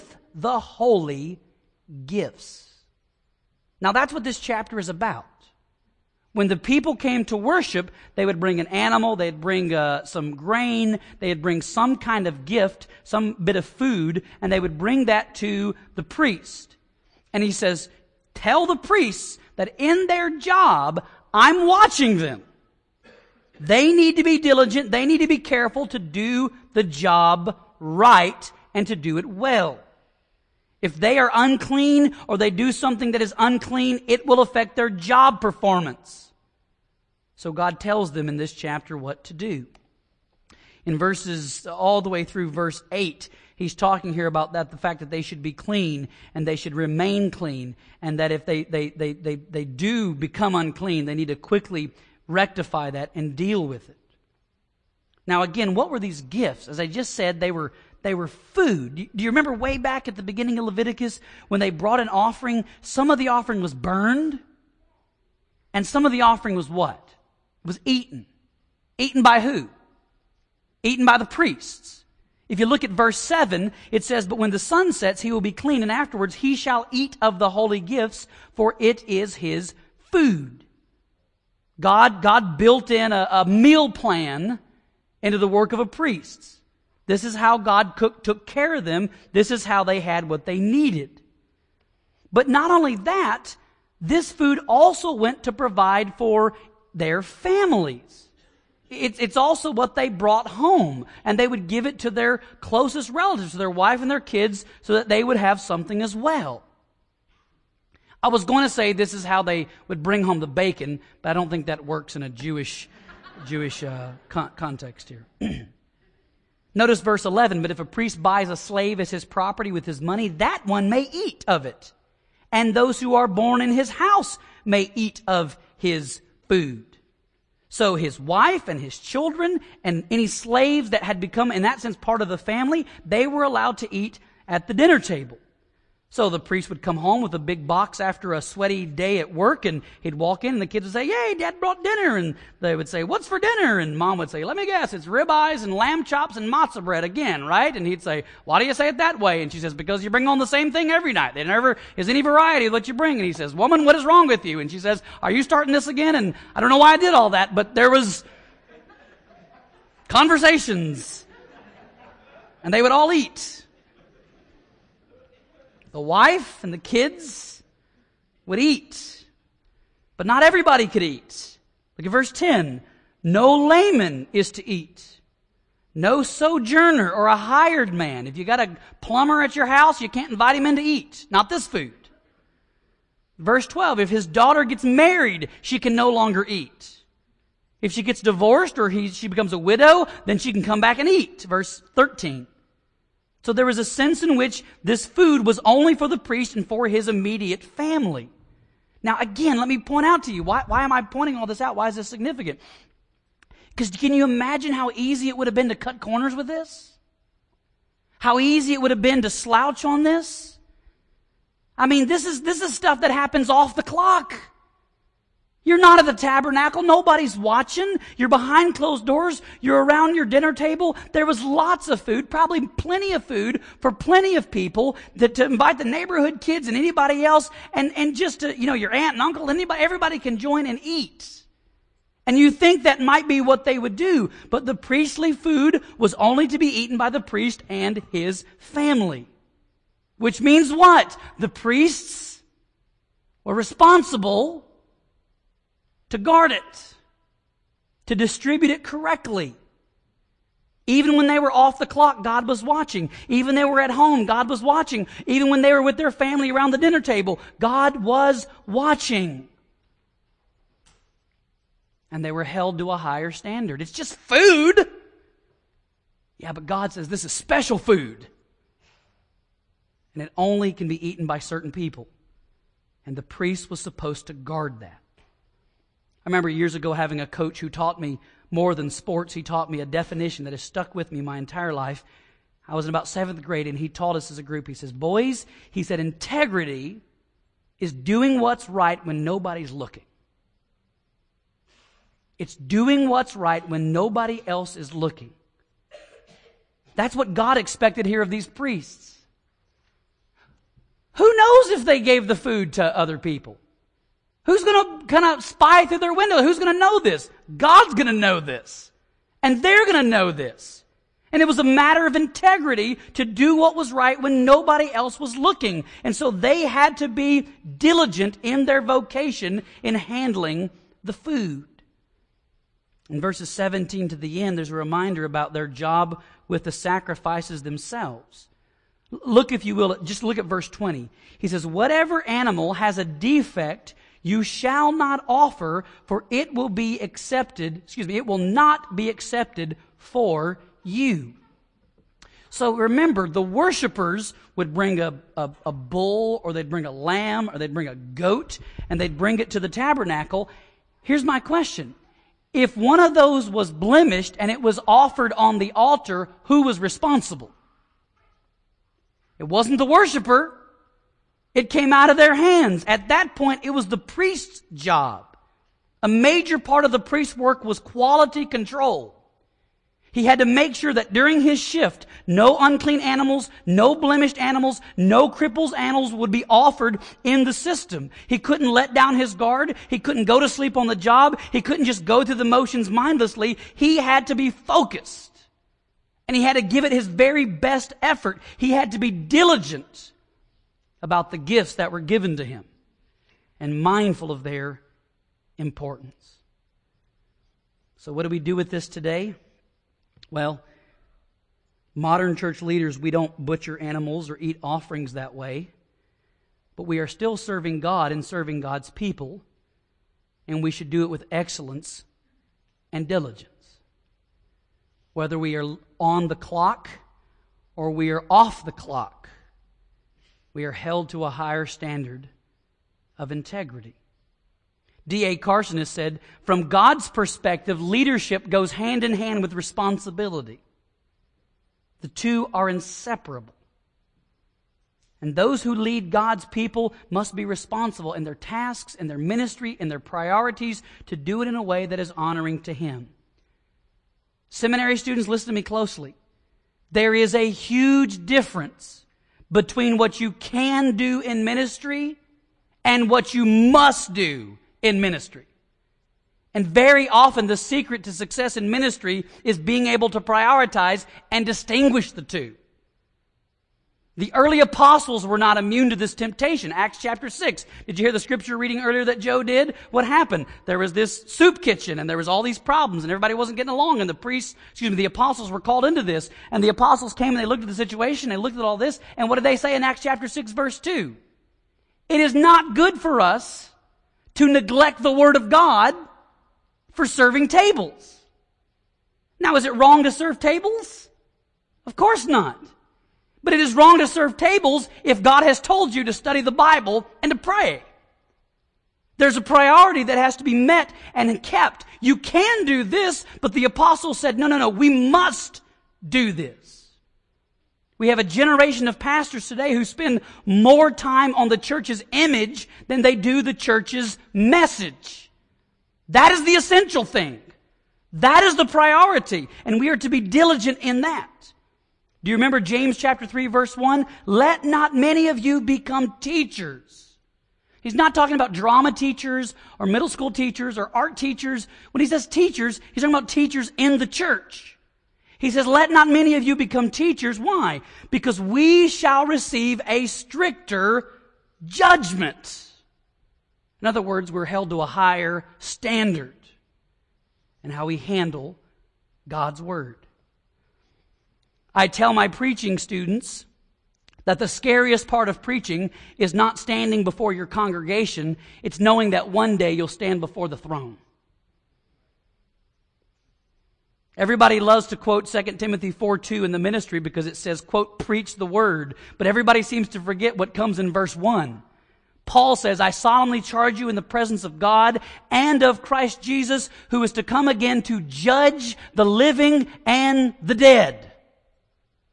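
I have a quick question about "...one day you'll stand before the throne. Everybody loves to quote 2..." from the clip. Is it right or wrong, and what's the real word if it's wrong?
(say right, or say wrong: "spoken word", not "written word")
right.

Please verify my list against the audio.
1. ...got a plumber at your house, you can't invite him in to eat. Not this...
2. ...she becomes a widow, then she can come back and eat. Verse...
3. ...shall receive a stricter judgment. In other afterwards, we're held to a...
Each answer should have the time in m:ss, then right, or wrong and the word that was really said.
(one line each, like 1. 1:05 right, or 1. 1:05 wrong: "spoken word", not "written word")
1. 2:58 right
2. 3:09 right
3. 8:58 wrong: "words", not "afterwards".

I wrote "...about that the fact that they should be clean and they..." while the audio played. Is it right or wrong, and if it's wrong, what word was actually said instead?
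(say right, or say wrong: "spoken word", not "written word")
right.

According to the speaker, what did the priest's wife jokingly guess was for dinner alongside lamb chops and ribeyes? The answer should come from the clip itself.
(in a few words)
matzo bread.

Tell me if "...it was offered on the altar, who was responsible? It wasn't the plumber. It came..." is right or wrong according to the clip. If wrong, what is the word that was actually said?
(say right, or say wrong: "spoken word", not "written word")
wrong: "worshiper", not "plumber".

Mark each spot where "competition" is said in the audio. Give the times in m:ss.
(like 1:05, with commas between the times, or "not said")
not said.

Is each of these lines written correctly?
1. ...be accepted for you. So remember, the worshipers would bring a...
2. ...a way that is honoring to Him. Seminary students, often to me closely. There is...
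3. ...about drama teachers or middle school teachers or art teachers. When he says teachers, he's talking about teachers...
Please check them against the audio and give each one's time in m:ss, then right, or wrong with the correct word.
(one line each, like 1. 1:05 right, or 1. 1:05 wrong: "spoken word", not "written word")
1. 5:38 right
2. 7:21 wrong: "listen", not "often"
3. 8:48 right.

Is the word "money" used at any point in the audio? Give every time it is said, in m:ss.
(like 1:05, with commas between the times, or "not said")
2:00.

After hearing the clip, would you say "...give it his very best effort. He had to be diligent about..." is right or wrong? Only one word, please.
right.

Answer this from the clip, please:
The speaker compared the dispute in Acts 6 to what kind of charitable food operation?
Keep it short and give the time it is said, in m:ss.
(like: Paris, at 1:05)
soup kitchen, at 7:51.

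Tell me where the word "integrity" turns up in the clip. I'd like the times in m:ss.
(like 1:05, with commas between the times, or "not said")
4:45, 5:12, 7:03.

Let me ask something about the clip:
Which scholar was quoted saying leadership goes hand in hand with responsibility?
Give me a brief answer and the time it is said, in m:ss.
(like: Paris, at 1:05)
D.A. Carson, at 7:05.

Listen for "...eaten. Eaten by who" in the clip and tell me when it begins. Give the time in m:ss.
1:07.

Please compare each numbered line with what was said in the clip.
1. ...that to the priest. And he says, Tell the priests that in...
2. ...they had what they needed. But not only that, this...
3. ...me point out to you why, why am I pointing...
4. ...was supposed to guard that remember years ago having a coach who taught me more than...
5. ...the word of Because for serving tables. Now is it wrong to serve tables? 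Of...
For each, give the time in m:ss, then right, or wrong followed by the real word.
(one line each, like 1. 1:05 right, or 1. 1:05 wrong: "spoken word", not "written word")
1. 0:15 right
2. 1:29 right
3. 3:19 right
4. 4:33 right
5. 8:05 wrong: "God", not "Because".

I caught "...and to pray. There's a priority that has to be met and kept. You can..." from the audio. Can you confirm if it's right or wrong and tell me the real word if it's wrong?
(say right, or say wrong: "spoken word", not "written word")
right.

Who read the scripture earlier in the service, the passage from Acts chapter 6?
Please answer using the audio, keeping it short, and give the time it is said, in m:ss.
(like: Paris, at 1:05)
Joe, at 7:49.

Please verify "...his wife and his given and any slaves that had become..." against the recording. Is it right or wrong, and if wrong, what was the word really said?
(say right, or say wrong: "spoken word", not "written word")
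wrong: "children", not "given".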